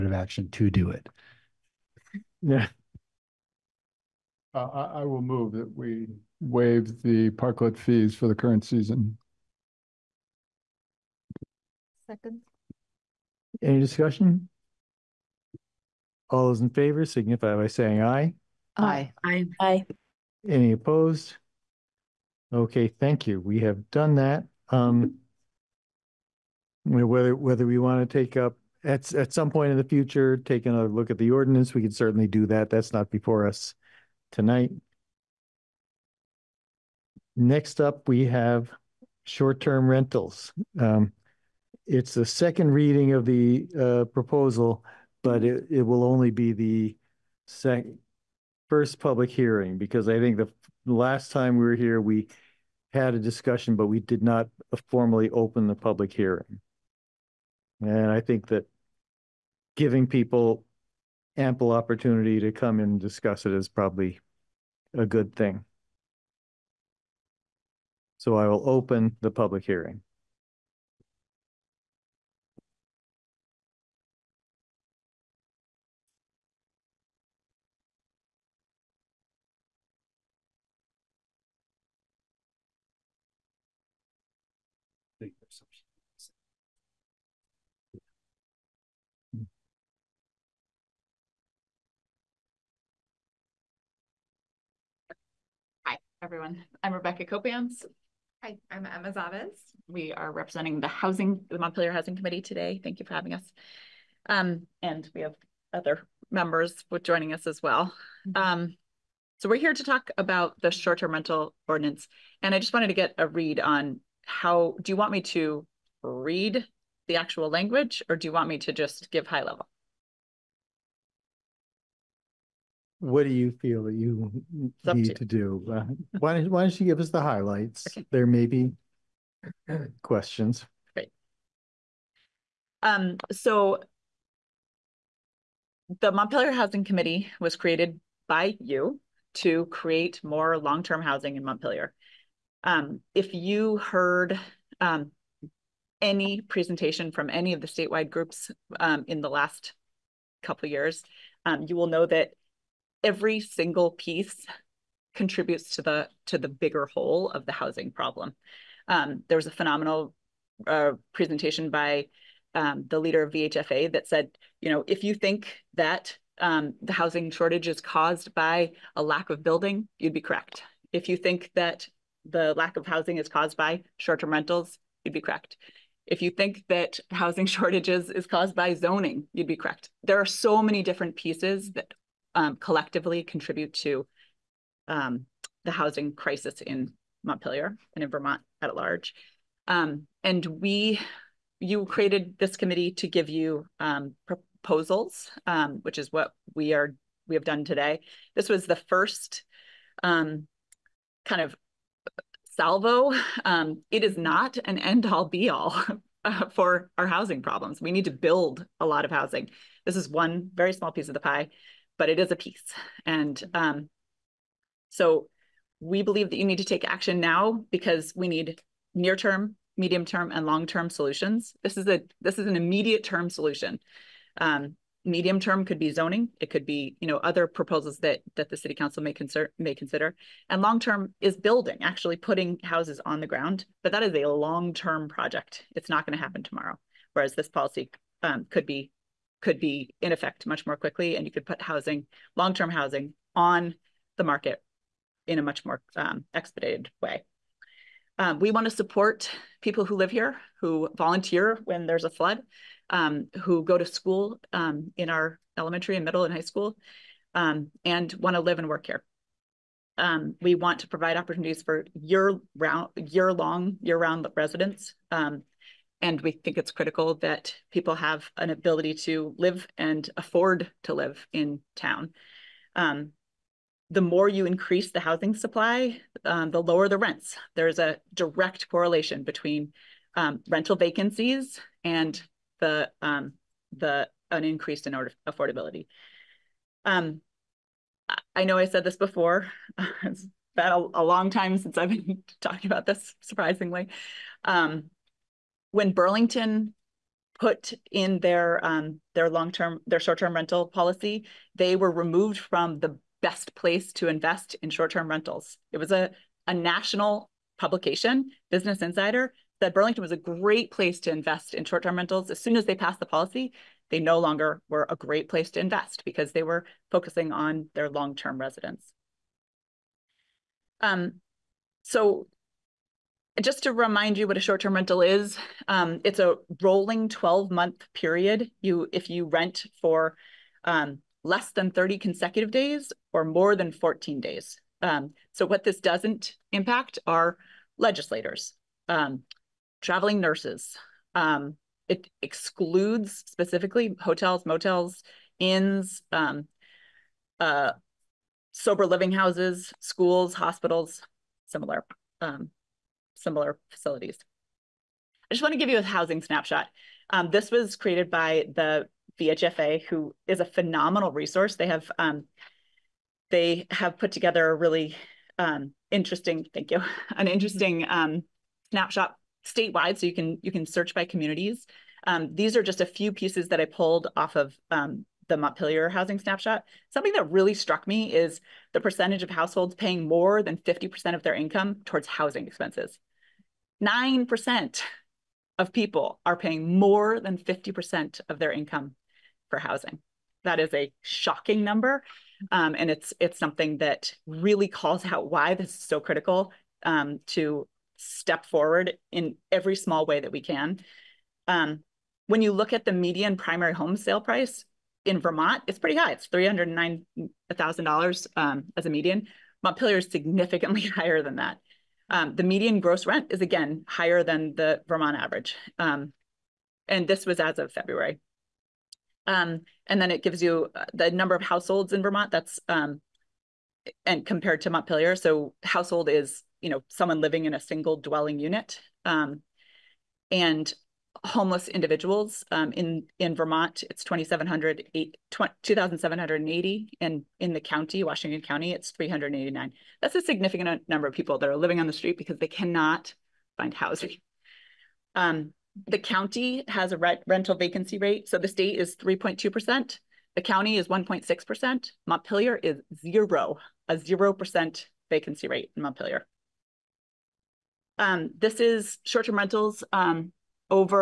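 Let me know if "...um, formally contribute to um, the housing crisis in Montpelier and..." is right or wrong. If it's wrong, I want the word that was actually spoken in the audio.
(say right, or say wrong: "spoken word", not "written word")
wrong: "collectively", not "formally".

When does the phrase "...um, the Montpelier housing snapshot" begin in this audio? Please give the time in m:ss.
6:14.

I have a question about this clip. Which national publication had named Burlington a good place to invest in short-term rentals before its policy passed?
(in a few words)
Business Insider.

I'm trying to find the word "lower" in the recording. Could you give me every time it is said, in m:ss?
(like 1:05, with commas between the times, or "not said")
4:36.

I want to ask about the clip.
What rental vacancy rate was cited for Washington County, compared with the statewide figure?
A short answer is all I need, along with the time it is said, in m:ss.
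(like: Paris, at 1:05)
1.6%, at 7:30.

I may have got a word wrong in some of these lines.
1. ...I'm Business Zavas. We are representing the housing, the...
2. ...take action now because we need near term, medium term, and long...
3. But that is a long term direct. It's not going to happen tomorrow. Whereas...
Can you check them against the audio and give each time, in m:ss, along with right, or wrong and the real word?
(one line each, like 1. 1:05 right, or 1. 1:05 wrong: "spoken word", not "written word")
1. 1:38 wrong: "Emma", not "Business"
2. 3:36 right
3. 3:53 wrong: "project", not "direct".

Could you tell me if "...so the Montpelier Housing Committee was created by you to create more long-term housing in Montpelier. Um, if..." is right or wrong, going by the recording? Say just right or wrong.
right.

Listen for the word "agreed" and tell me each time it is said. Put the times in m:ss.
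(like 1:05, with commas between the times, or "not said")
not said.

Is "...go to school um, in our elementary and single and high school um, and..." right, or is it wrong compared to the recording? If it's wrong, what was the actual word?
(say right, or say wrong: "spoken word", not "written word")
wrong: "middle", not "single".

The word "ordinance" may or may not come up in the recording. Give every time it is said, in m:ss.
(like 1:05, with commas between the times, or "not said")
0:31, 1:51.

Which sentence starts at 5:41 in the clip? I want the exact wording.
Um, it excludes specifically hotels, motels, inns, um, uh, sober living houses, schools, hospitals, similar.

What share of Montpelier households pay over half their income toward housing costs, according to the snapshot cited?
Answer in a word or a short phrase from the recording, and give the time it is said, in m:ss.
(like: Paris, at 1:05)
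9%, at 6:23.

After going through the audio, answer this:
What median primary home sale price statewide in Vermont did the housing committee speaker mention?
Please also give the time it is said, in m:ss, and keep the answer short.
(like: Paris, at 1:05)
$309,000, at 6:46.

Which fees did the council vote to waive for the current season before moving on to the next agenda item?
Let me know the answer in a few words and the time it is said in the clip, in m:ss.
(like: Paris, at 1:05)
Parklet fees, at 0:07.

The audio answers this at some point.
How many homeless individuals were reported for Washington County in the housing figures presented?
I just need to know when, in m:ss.
7:18.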